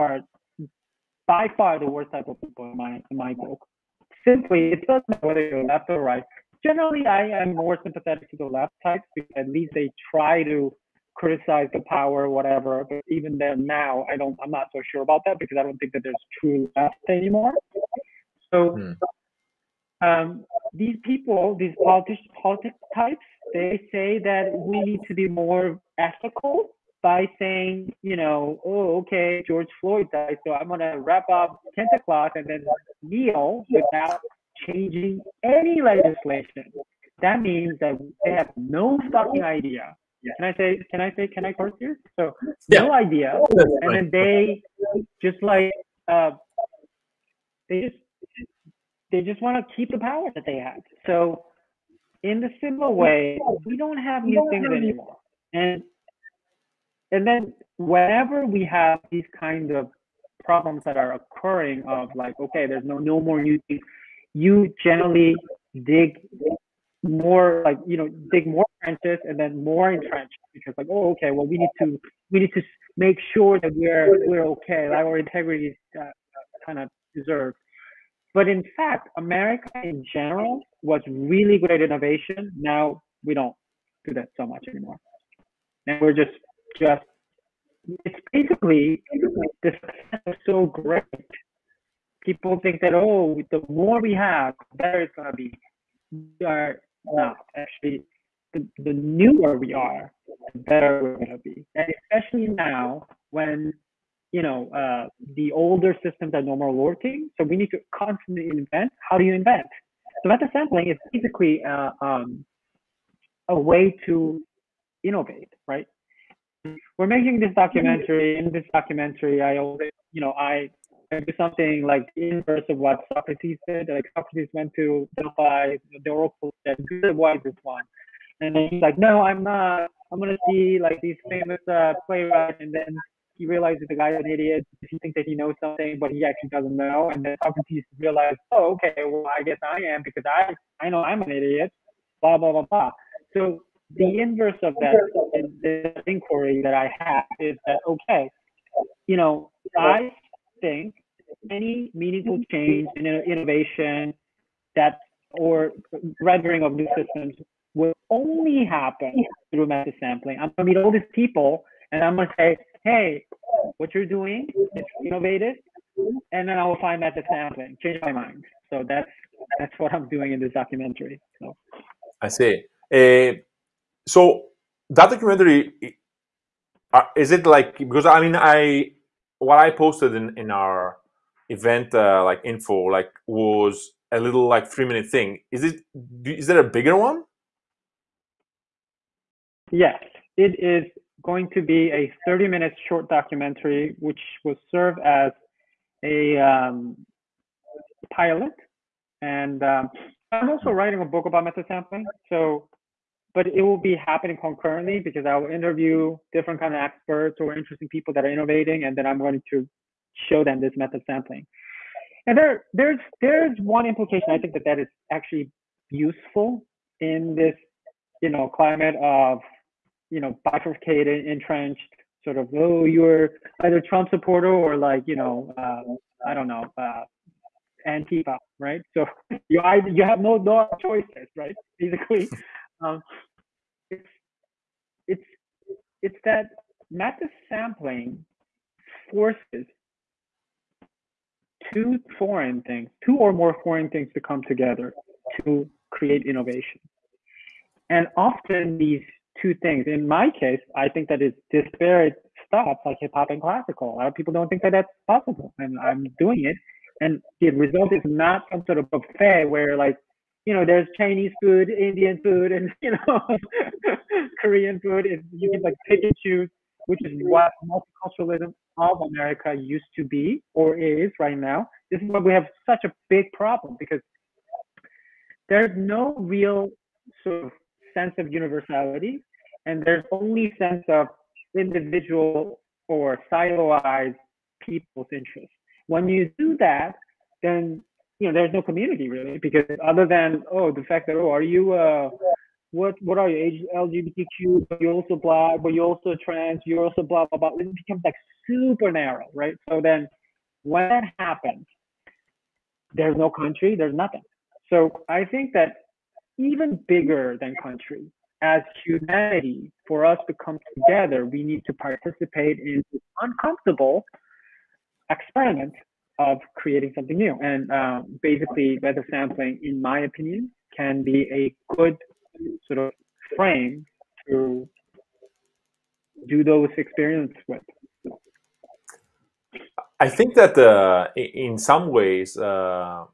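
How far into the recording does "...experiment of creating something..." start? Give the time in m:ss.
5:15.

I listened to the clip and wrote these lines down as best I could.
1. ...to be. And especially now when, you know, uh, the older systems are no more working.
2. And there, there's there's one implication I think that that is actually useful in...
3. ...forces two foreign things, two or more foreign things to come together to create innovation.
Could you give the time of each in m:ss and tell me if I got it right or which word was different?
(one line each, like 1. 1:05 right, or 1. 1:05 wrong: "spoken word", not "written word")
1. 1:41 right
2. 3:32 right
3. 3:59 right.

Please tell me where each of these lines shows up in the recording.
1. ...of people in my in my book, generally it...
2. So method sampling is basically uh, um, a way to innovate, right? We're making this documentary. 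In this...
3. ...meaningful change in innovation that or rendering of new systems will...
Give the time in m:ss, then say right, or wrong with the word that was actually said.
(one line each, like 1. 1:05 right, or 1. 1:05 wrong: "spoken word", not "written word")
1. 0:02 wrong: "simply", not "generally"
2. 1:50 right
3. 2:31 right.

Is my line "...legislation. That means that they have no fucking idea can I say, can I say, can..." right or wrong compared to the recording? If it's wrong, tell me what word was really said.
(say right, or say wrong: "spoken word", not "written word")
right.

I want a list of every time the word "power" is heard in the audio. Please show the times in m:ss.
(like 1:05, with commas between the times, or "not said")
0:11, 0:49.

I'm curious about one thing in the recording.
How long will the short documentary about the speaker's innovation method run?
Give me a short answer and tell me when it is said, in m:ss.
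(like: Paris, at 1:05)
30 minutes, at 3:12.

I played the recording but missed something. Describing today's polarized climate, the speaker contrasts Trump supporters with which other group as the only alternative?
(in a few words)
Antifa.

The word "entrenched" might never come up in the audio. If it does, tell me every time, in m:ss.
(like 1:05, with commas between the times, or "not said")
1:09, 3:41.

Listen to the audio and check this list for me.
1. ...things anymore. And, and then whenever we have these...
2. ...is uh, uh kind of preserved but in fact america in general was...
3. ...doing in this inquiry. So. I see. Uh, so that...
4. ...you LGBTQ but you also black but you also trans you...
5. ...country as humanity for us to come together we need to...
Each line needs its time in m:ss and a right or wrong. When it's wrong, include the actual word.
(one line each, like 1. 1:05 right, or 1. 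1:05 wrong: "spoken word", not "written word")
1. 0:54 right
2. 1:15 right
3. 2:50 wrong: "documentary", not "inquiry"
4. 4:53 right
5. 5:07 right.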